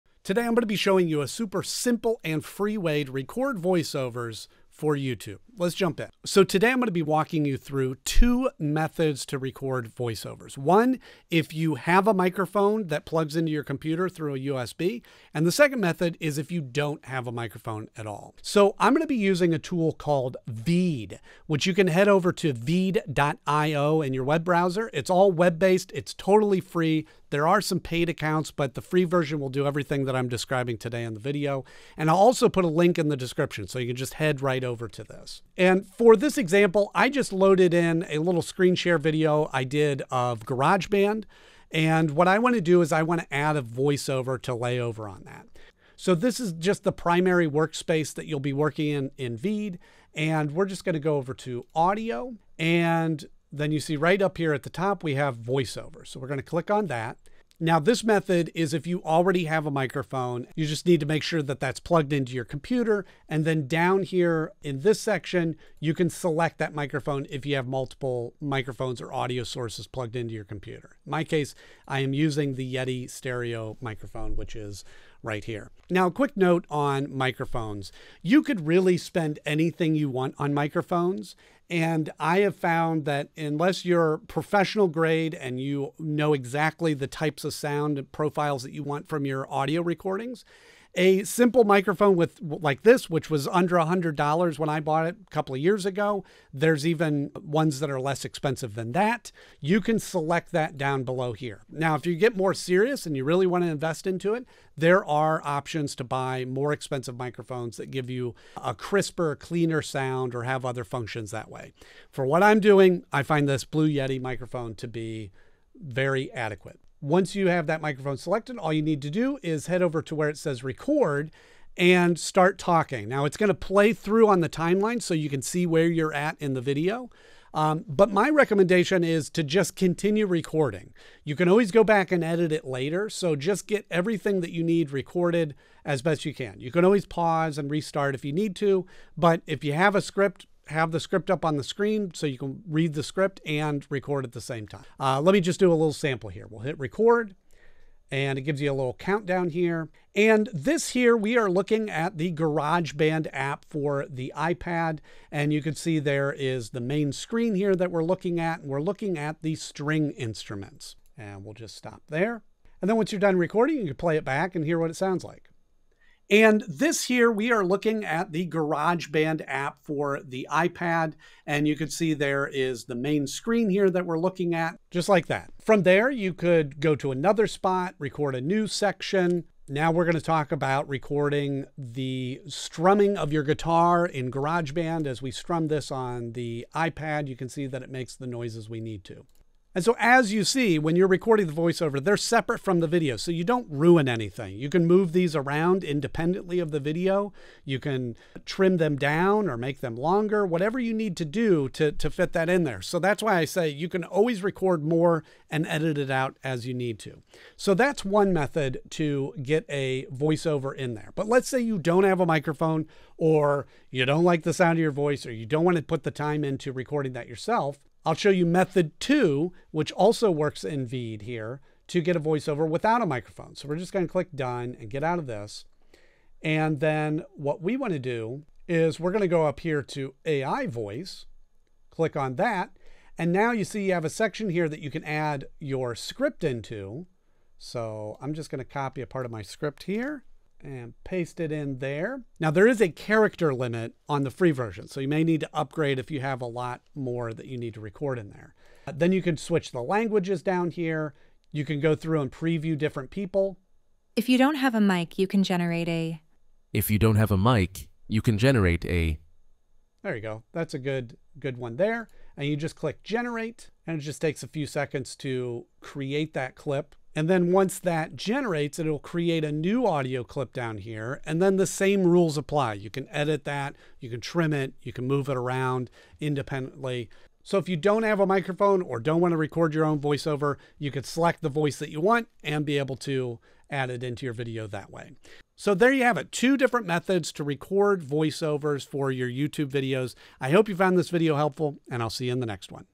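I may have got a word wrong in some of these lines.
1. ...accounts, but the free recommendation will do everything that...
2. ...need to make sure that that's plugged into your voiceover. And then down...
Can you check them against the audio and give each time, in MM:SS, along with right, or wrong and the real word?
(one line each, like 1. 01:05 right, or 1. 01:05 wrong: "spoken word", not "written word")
1. 00:28 wrong: "version", not "recommendation"
2. 01:00 wrong: "computer", not "voiceover".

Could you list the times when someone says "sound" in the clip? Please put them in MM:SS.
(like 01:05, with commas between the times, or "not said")
01:27, 01:49, 02:44, 03:34.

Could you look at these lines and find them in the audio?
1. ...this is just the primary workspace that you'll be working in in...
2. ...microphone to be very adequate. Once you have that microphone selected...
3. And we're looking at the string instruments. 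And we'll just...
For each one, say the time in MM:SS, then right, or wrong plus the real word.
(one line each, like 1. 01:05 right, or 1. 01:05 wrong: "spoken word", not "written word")
1. 00:46 right
2. 01:54 right
3. 02:38 right.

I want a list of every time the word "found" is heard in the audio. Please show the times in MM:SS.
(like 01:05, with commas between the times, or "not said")
01:22, 04:50.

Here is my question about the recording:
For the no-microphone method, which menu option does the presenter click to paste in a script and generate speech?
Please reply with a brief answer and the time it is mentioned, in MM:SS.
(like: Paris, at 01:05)
AI voice, at 03:50.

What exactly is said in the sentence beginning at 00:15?
And the second method is if you don't have a microphone at all.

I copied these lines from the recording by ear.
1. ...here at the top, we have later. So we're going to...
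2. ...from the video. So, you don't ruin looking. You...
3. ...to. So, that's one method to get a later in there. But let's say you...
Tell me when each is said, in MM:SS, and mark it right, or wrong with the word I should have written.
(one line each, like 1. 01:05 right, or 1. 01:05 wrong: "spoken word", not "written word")
1. 00:54 wrong: "voiceover", not "later"
2. 03:12 wrong: "anything", not "looking"
3. 03:26 wrong: "voiceover", not "later".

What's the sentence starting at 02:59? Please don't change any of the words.
Now we're going to talk about recording the strumming of your guitar in GarageBand.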